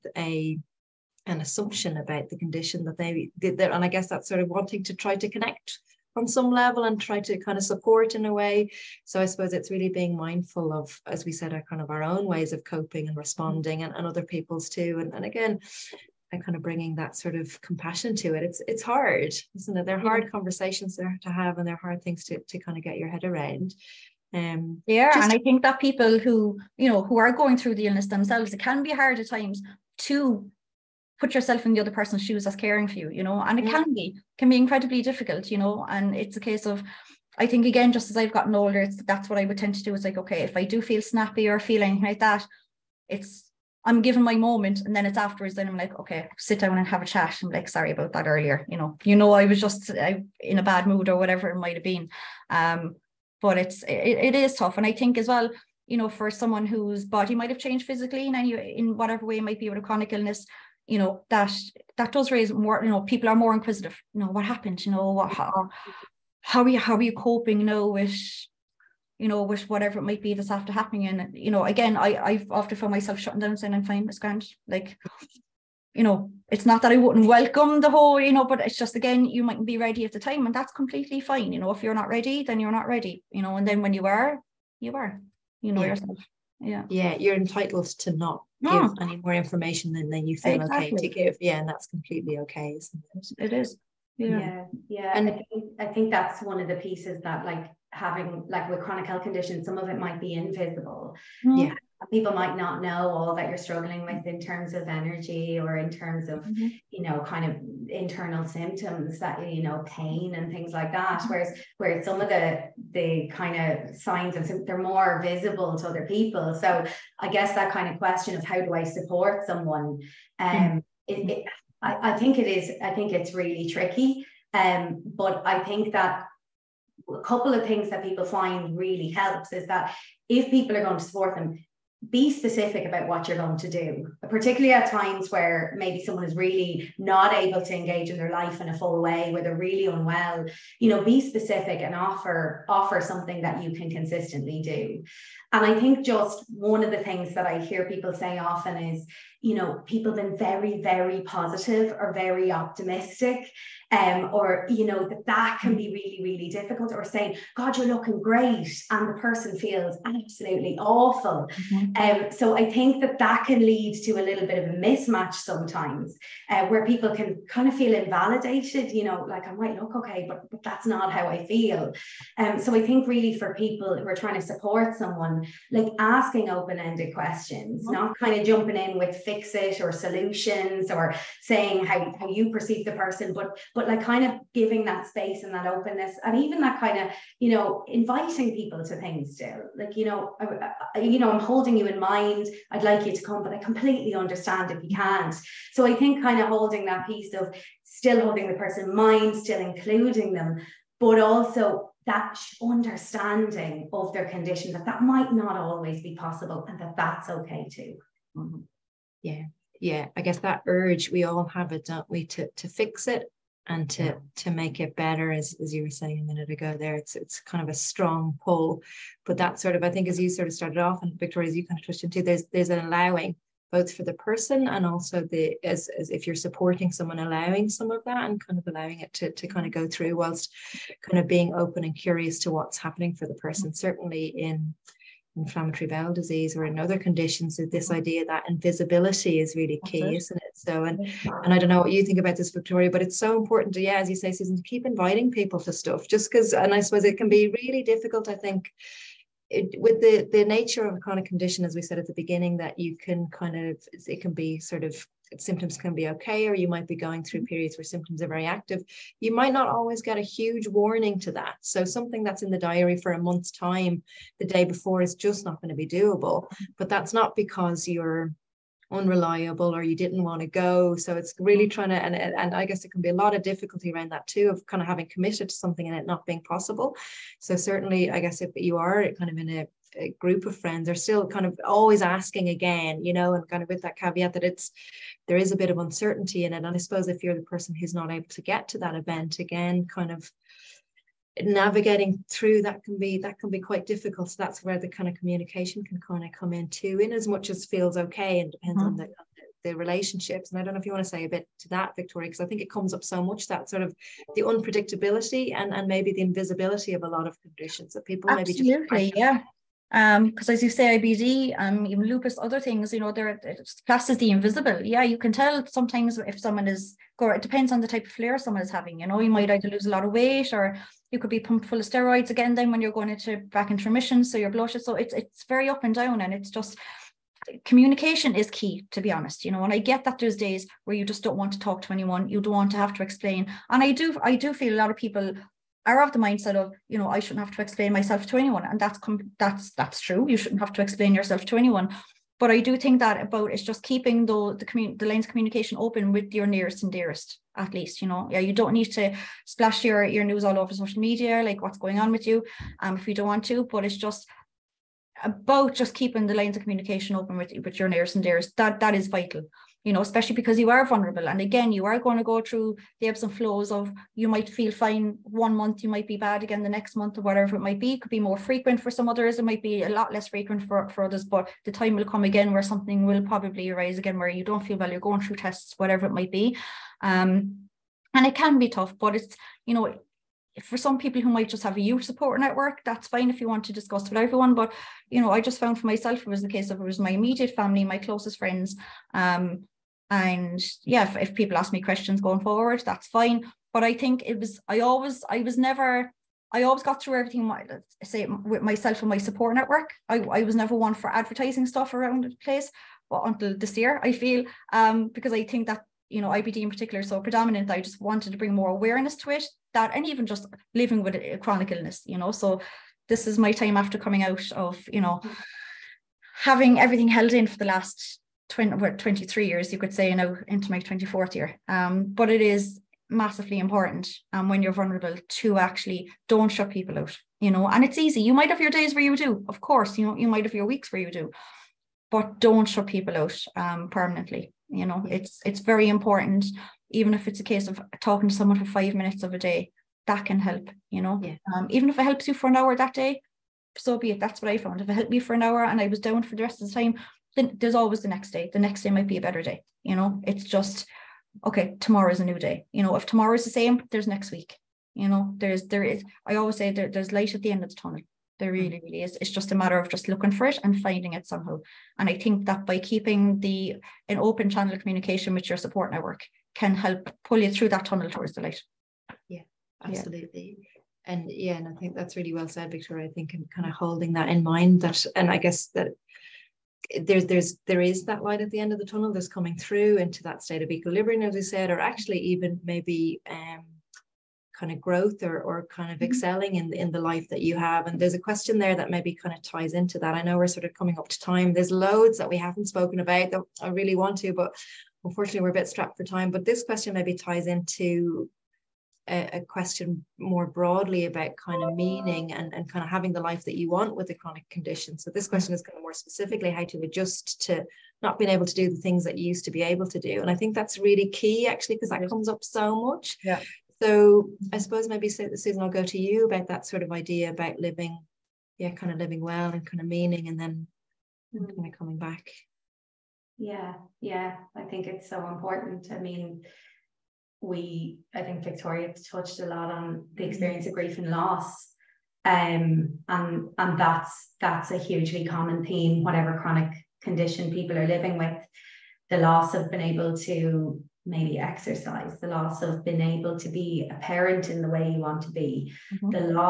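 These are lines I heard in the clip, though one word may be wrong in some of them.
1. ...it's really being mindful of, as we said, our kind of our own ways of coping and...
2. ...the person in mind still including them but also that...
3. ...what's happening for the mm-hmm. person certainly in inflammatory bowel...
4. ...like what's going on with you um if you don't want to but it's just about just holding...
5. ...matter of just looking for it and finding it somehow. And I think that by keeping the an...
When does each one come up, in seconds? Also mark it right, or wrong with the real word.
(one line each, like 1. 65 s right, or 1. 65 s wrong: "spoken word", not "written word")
1. 9 s right
2. 198 s right
3. 232 s right
4. 351 s wrong: "keeping", not "holding"
5. 459 s right.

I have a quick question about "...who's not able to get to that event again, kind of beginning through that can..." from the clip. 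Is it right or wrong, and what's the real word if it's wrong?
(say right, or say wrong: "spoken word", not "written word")
wrong: "navigating", not "beginning".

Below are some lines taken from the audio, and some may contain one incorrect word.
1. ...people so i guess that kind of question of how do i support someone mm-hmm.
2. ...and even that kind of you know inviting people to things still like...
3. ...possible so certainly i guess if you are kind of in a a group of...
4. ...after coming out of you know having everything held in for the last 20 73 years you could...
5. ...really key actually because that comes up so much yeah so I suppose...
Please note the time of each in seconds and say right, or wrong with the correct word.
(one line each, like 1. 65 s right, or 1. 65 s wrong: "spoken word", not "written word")
1. 116 s right
2. 186 s right
3. 276 s right
4. 413 s wrong: "23", not "73"
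5. 510 s right.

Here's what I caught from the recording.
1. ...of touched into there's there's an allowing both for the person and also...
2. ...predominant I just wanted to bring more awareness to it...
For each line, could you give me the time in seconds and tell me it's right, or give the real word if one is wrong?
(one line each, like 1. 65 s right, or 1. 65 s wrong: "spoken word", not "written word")
1. 221 s right
2. 407 s right.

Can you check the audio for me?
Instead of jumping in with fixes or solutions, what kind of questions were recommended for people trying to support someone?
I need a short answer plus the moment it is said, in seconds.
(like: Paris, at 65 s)
Open-ended questions, at 176 s.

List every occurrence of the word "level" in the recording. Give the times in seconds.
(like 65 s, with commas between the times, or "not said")
6 s.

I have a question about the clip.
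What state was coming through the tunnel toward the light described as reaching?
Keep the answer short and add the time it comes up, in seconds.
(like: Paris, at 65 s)
Equilibrium, at 480 s.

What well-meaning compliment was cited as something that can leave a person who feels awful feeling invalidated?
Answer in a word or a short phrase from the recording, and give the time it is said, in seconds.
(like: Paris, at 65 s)
You're looking great, at 157 s.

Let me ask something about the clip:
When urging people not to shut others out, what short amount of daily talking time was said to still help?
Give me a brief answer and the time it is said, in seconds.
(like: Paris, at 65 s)
Five minutes, at 438 s.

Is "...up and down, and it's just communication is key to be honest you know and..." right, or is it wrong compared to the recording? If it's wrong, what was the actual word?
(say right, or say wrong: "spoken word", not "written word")
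right.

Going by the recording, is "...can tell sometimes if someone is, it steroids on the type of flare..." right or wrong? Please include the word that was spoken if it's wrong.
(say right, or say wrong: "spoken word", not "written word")
wrong: "depends", not "steroids".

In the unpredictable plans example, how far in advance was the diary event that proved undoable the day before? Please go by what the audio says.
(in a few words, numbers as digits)
A month.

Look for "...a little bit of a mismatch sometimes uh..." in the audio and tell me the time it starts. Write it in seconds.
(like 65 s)
164 s.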